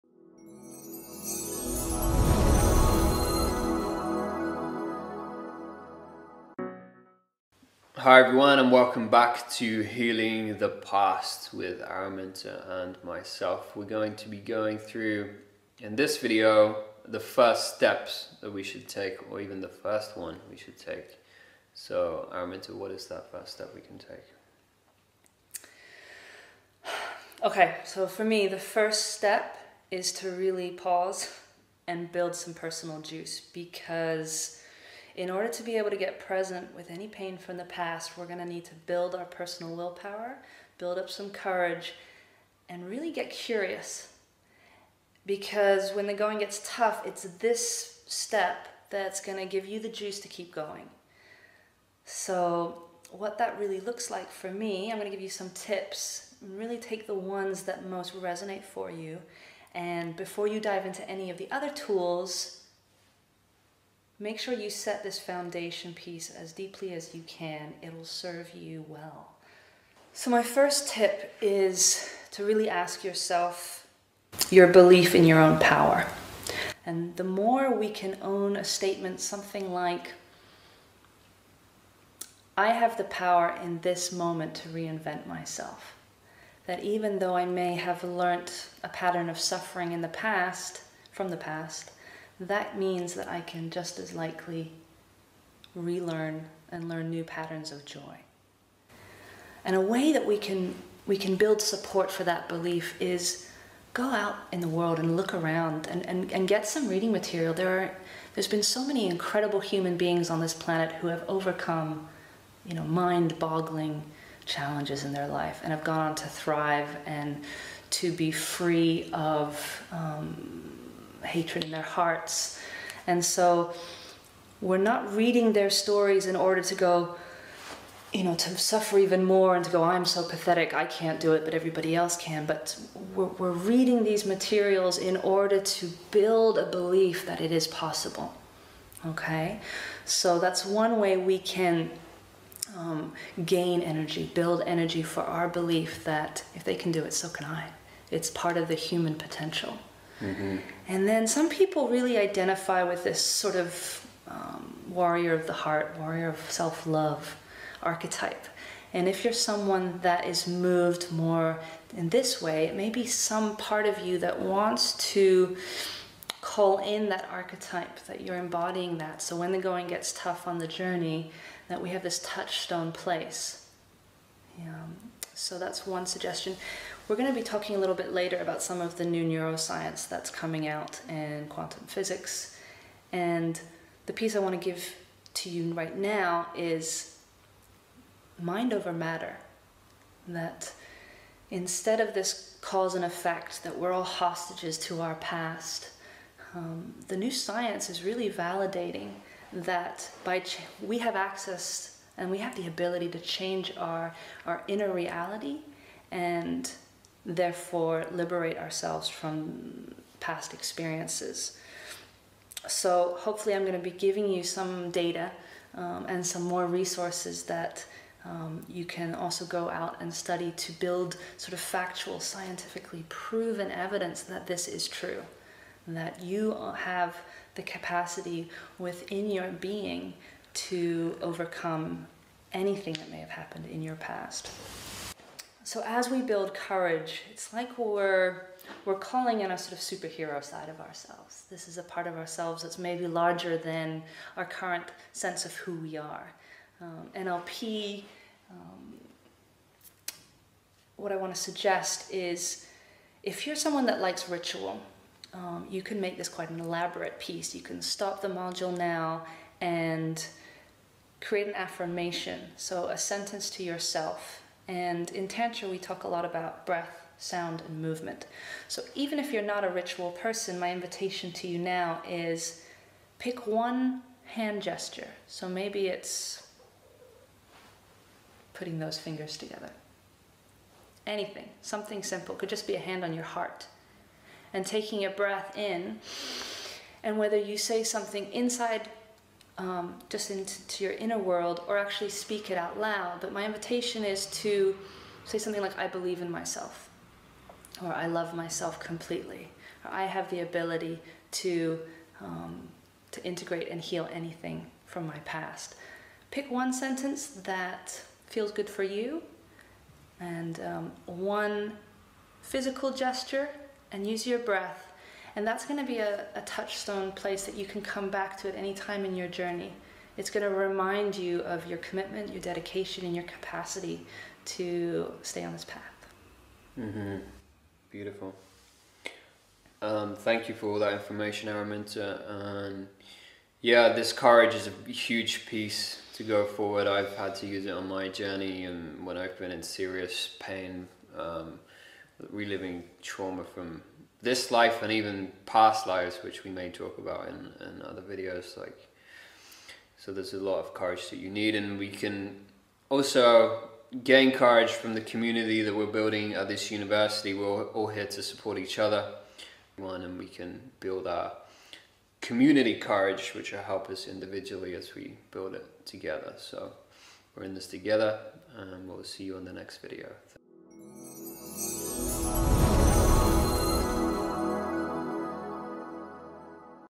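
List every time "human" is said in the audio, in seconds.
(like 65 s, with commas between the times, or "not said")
109 s, 148 s.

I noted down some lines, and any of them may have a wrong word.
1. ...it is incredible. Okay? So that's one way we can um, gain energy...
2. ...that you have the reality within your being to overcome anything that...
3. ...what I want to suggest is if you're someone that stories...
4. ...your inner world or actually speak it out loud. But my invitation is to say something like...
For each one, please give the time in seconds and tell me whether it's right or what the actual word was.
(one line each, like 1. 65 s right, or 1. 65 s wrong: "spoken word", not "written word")
1. 137 s wrong: "possible", not "incredible"
2. 225 s wrong: "capacity", not "reality"
3. 250 s wrong: "likes", not "stories"
4. 290 s right.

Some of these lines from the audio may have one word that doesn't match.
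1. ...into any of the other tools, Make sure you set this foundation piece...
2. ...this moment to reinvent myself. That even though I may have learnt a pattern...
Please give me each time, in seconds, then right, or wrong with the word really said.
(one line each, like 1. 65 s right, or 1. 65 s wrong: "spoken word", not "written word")
1. 60 s right
2. 83 s right.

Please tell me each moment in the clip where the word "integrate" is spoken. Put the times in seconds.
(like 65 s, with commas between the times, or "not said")
303 s.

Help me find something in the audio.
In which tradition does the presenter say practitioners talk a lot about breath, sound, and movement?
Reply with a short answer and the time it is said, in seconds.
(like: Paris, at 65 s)
Tantra, at 265 s.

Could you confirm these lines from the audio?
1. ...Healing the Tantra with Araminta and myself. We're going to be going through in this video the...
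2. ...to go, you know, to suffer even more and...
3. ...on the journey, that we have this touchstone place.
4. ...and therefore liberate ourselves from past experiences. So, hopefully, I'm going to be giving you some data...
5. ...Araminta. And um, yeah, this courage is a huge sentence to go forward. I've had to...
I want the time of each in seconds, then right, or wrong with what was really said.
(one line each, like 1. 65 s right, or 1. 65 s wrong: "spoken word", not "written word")
1. 9 s wrong: "Past", not "Tantra"
2. 126 s right
3. 170 s right
4. 206 s right
5. 331 s wrong: "piece", not "sentence".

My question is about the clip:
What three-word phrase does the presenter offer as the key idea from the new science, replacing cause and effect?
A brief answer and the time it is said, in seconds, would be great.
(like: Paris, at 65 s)
mind over matter, at 188 s.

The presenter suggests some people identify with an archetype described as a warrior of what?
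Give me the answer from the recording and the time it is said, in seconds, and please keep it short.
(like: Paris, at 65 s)
the heart, at 154 s.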